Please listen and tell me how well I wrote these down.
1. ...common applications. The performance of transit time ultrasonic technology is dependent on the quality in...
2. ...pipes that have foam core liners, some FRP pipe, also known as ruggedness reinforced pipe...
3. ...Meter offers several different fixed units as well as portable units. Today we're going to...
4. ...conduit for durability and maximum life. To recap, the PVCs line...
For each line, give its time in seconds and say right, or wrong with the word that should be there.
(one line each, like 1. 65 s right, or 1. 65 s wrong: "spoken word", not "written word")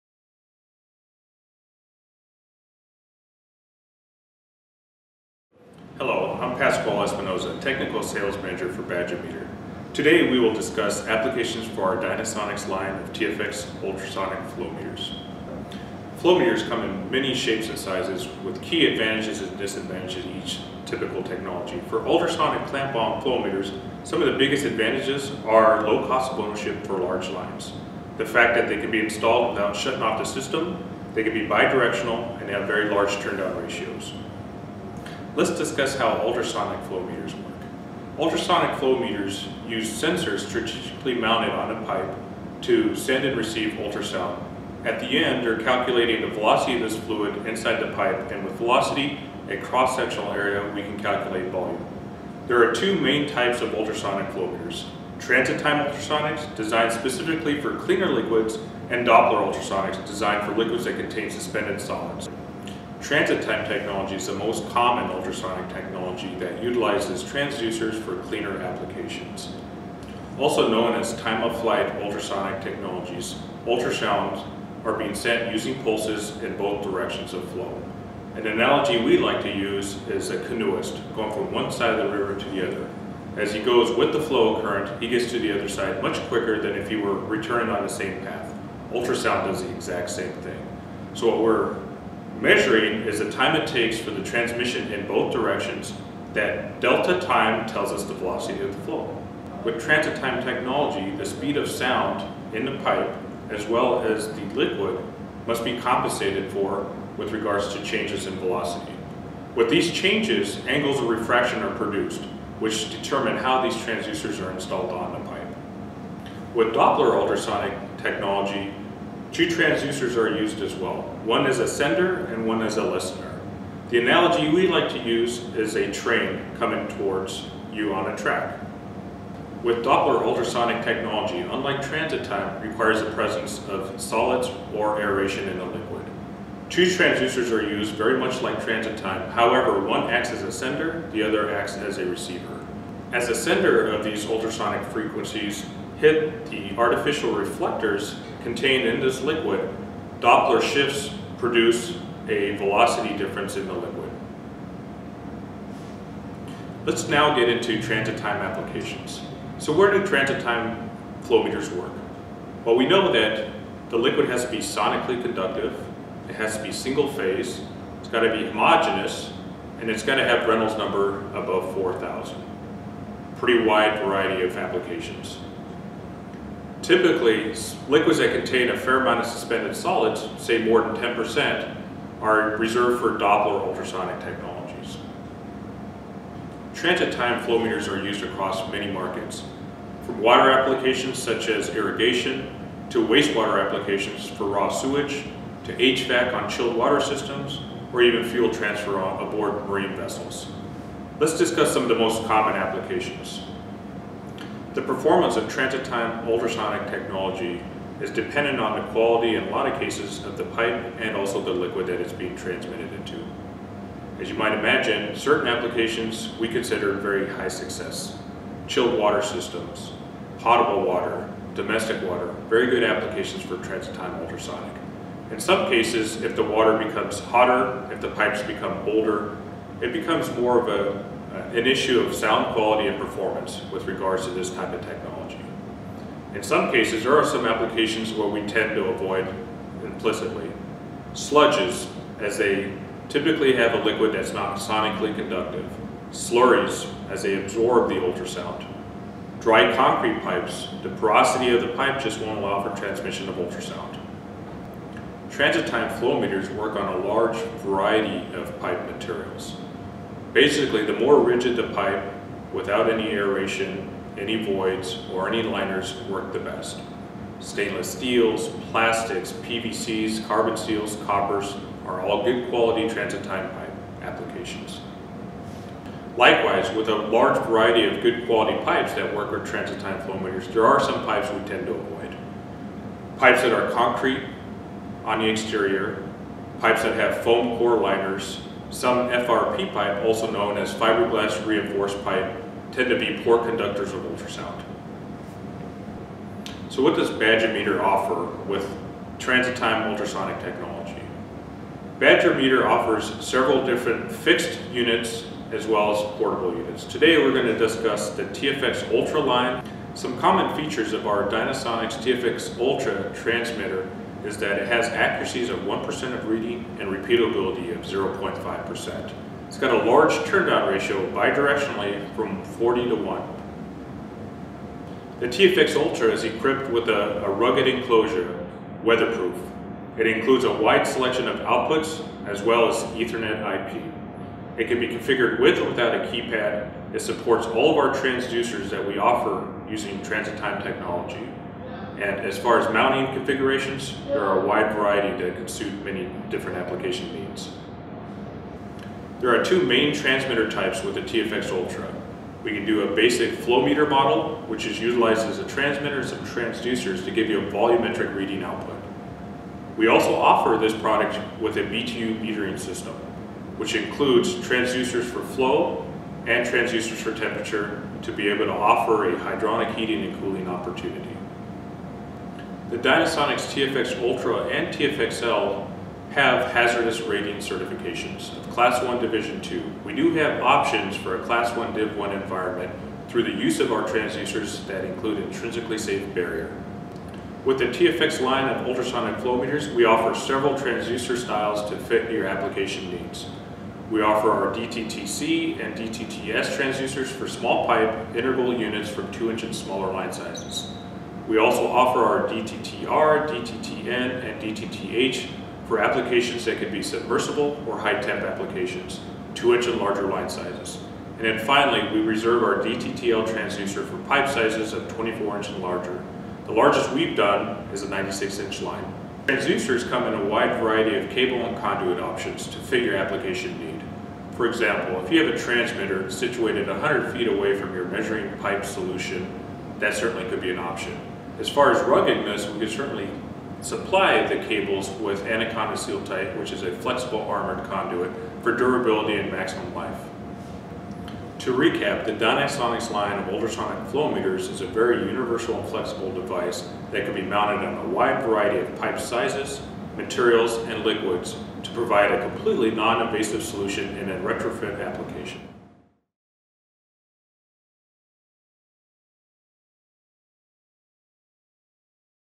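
1. 202 s right
2. 286 s wrong: "fiberglass", not "ruggedness"
3. 302 s right
4. 437 s wrong: "Dynasonics", not "PVCs".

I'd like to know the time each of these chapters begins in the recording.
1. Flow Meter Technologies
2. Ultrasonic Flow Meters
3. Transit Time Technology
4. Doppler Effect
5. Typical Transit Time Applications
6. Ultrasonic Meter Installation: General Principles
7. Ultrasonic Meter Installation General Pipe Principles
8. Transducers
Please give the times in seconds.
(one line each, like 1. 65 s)
1. 16 s
2. 39 s
3. 100 s
4. 130 s
5. 187 s
6. 255 s
7. 283 s
8. 388 s.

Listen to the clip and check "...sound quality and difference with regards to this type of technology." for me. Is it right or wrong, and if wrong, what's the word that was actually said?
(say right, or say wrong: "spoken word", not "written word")
wrong: "performance", not "difference".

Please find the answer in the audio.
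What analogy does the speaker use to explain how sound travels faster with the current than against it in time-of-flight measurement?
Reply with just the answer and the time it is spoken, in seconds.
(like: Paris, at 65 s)
A canoeist, at 80 s.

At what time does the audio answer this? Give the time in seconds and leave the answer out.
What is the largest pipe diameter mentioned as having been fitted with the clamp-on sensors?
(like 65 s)
417 s.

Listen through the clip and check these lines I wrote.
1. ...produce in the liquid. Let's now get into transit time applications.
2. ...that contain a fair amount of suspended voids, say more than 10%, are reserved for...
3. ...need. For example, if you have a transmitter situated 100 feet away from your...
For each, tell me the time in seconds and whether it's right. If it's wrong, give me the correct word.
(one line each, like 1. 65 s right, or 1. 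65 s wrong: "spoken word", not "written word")
1. 153 s wrong: "difference", not "produce"
2. 178 s wrong: "solids", not "voids"
3. 423 s right.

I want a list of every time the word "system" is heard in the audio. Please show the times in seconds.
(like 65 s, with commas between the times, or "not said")
30 s, 196 s, 219 s, 362 s.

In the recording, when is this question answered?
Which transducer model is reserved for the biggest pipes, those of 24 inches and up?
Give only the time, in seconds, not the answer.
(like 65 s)
412 s.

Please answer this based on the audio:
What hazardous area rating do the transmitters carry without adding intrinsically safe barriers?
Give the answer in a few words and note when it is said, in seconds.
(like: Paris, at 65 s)
Class 1 Division 2, at 378 s.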